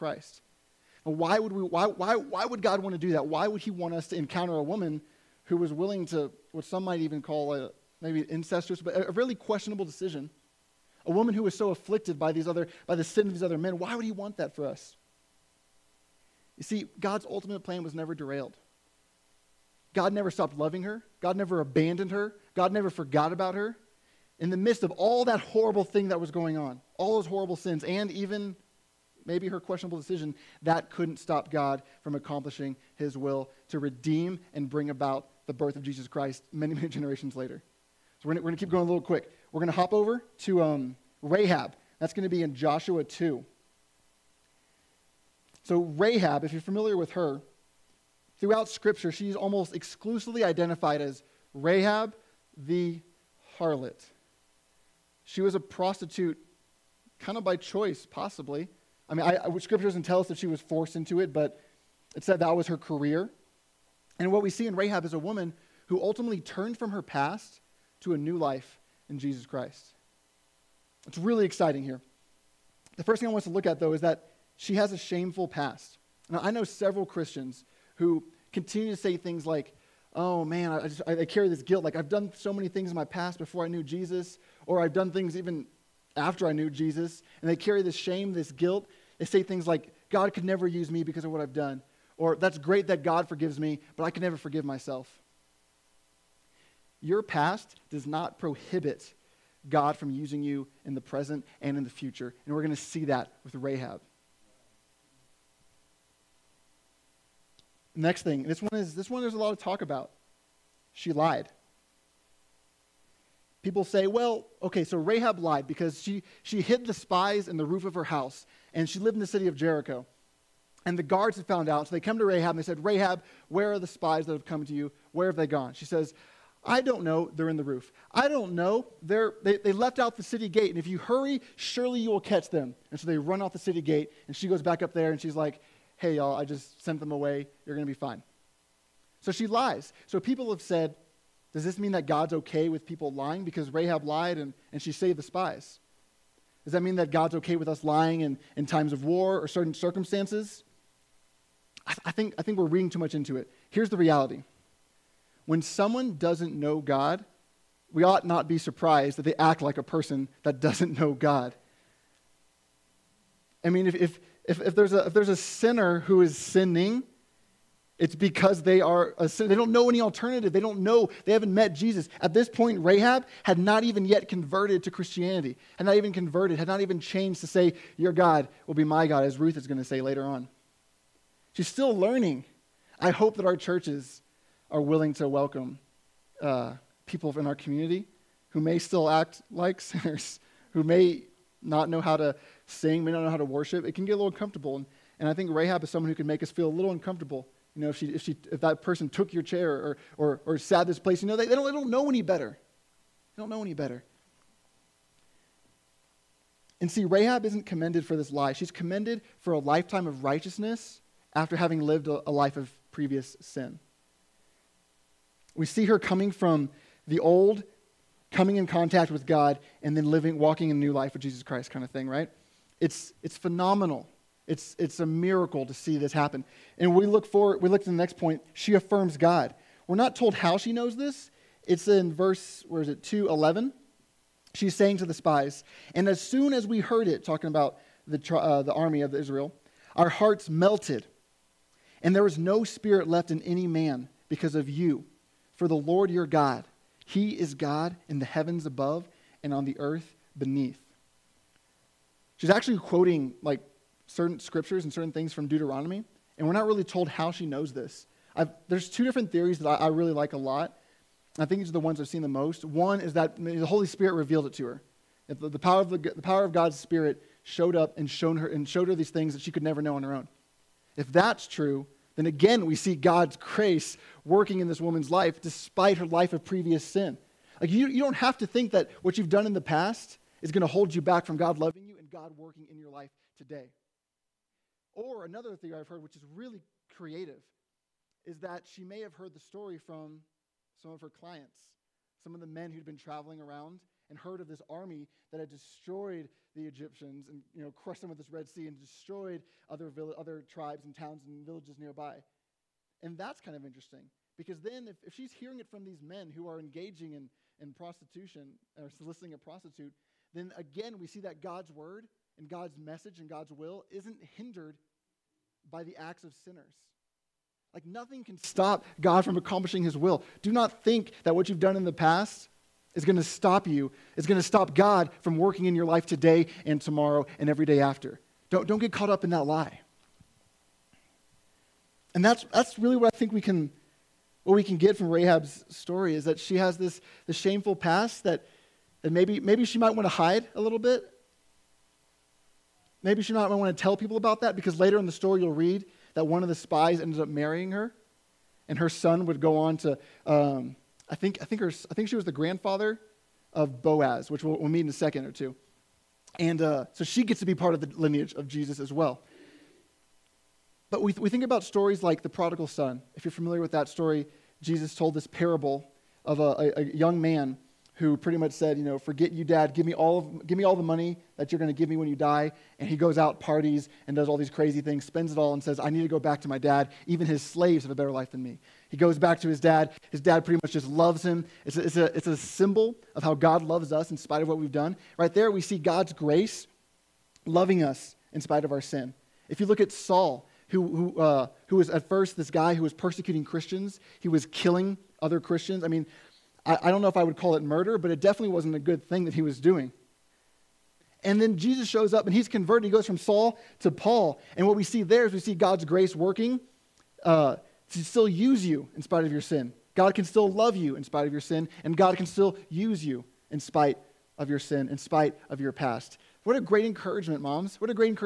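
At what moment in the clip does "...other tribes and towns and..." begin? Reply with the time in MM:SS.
05:00.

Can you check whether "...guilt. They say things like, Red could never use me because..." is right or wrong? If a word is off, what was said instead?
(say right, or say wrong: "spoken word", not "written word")
wrong: "God", not "Red".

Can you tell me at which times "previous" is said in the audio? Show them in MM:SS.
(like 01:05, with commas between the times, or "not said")
03:32, 04:36.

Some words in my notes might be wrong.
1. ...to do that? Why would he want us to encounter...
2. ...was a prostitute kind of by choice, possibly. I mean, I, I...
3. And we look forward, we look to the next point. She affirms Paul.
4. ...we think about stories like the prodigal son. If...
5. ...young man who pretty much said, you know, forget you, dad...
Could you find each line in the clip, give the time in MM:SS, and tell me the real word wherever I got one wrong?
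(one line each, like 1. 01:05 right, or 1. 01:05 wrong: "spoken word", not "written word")
1. 00:02 right
2. 00:55 right
3. 03:46 wrong: "God", not "Paul"
4. 06:01 right
5. 06:06 right.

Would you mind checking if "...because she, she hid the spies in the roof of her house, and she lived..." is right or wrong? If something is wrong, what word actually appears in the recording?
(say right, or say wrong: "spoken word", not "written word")
right.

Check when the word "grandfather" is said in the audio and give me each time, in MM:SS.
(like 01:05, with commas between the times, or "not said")
05:52.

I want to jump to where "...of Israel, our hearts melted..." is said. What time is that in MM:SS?
03:59.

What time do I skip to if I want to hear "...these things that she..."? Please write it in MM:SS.
04:28.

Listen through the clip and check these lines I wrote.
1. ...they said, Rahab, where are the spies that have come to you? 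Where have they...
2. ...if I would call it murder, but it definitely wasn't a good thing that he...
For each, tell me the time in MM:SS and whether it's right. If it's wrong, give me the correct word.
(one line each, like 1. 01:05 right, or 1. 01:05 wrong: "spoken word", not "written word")
1. 02:02 right
2. 06:37 right.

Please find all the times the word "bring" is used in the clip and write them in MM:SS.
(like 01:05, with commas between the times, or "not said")
00:34.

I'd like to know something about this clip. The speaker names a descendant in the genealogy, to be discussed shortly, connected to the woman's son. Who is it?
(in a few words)
Boaz.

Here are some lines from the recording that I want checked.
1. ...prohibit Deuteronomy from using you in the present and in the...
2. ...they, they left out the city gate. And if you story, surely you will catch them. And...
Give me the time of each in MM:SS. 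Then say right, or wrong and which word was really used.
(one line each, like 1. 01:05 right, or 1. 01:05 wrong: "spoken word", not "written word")
1. 01:38 wrong: "God", not "Deuteronomy"
2. 02:09 wrong: "hurry", not "story".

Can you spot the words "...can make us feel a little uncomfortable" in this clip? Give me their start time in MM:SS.
03:16.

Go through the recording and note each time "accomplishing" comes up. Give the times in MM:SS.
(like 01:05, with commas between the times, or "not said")
00:32, 05:19.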